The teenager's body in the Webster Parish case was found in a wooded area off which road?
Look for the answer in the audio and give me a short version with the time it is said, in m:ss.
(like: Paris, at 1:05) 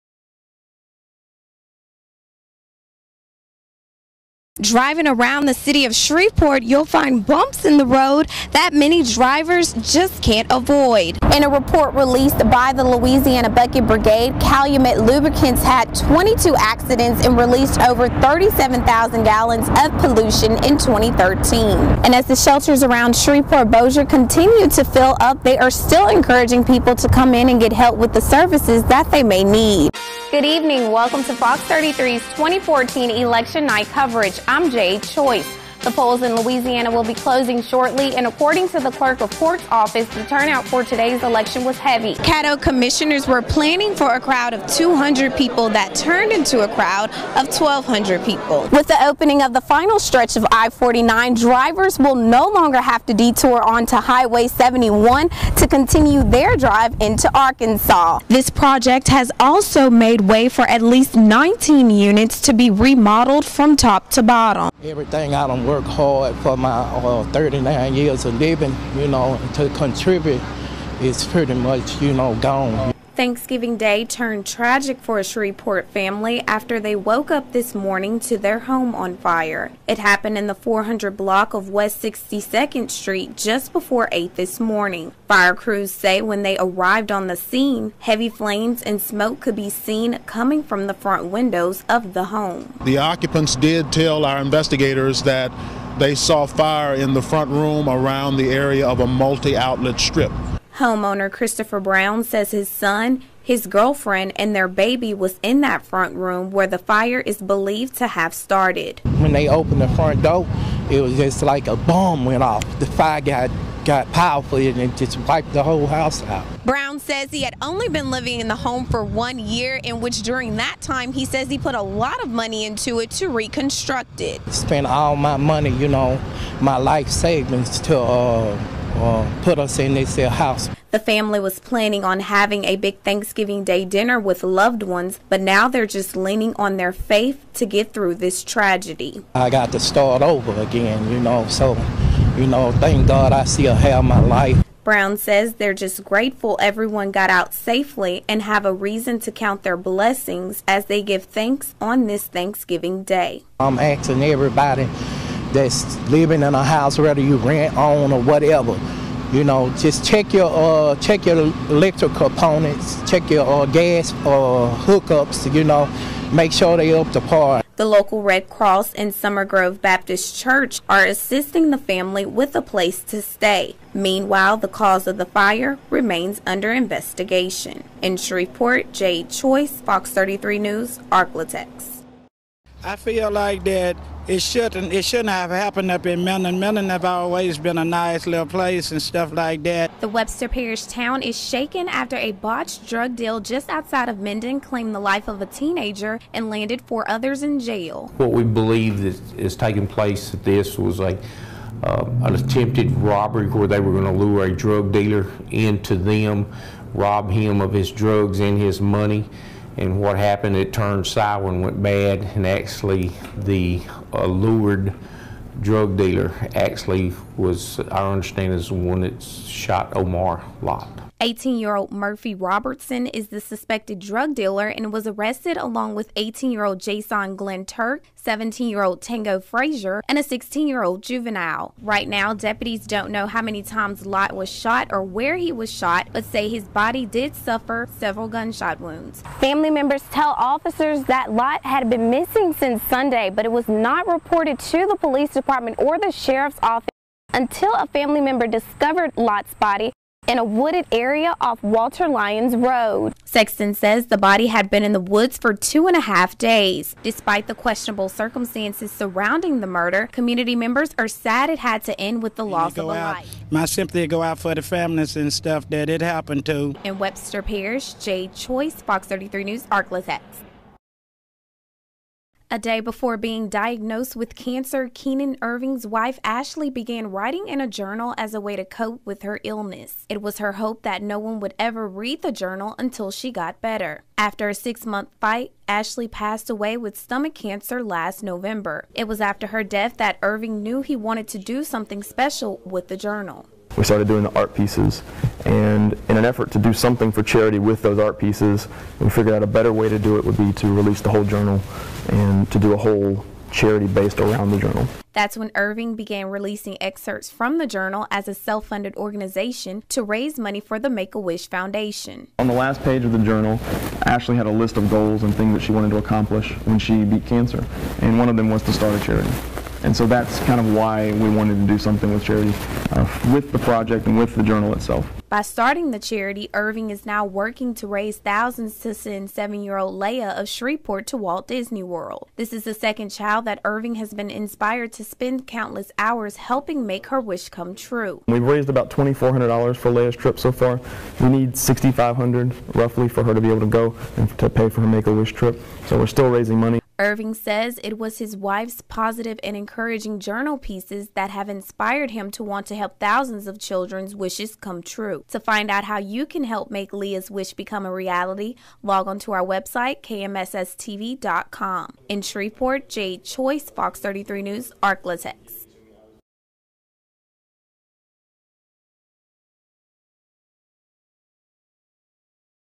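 Walter Lyons Road, at 4:11.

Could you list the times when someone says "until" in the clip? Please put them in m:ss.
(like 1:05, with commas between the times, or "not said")
4:07, 4:42.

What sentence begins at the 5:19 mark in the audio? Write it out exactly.
And so that's kind of why we wanted to do something with charity, uh, with the project and with the journal itself.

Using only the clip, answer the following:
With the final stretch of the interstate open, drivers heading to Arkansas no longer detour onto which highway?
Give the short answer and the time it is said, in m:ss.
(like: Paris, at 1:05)
Highway 71, at 0:53.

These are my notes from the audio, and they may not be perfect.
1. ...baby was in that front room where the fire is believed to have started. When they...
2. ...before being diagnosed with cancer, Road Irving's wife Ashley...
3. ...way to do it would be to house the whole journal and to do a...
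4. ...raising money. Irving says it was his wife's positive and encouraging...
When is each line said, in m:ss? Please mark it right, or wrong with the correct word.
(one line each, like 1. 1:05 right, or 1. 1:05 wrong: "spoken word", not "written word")
1. 1:44 right
2. 4:32 wrong: "Keenan", not "Road"
3. 4:59 wrong: "release", not "house"
4. 5:46 right.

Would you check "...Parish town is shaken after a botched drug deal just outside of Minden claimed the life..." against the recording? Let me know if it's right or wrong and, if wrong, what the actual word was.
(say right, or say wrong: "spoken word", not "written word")
right.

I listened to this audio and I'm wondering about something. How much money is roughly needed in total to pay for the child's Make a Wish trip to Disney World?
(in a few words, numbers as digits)
$6,500.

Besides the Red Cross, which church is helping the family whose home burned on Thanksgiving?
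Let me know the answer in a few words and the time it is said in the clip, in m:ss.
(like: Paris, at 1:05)
Summer Grove Baptist Church, at 2:49.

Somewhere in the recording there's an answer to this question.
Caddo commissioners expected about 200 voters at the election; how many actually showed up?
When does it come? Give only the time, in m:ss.
0:47.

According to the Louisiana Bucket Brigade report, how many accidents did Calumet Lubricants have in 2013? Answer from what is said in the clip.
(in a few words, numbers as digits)
22.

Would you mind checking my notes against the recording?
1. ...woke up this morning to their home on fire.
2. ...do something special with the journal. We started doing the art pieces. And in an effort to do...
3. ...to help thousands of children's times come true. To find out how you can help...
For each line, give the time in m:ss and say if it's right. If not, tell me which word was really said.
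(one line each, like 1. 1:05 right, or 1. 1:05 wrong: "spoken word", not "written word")
1. 1:16 right
2. 4:51 right
3. 5:52 wrong: "wishes", not "times".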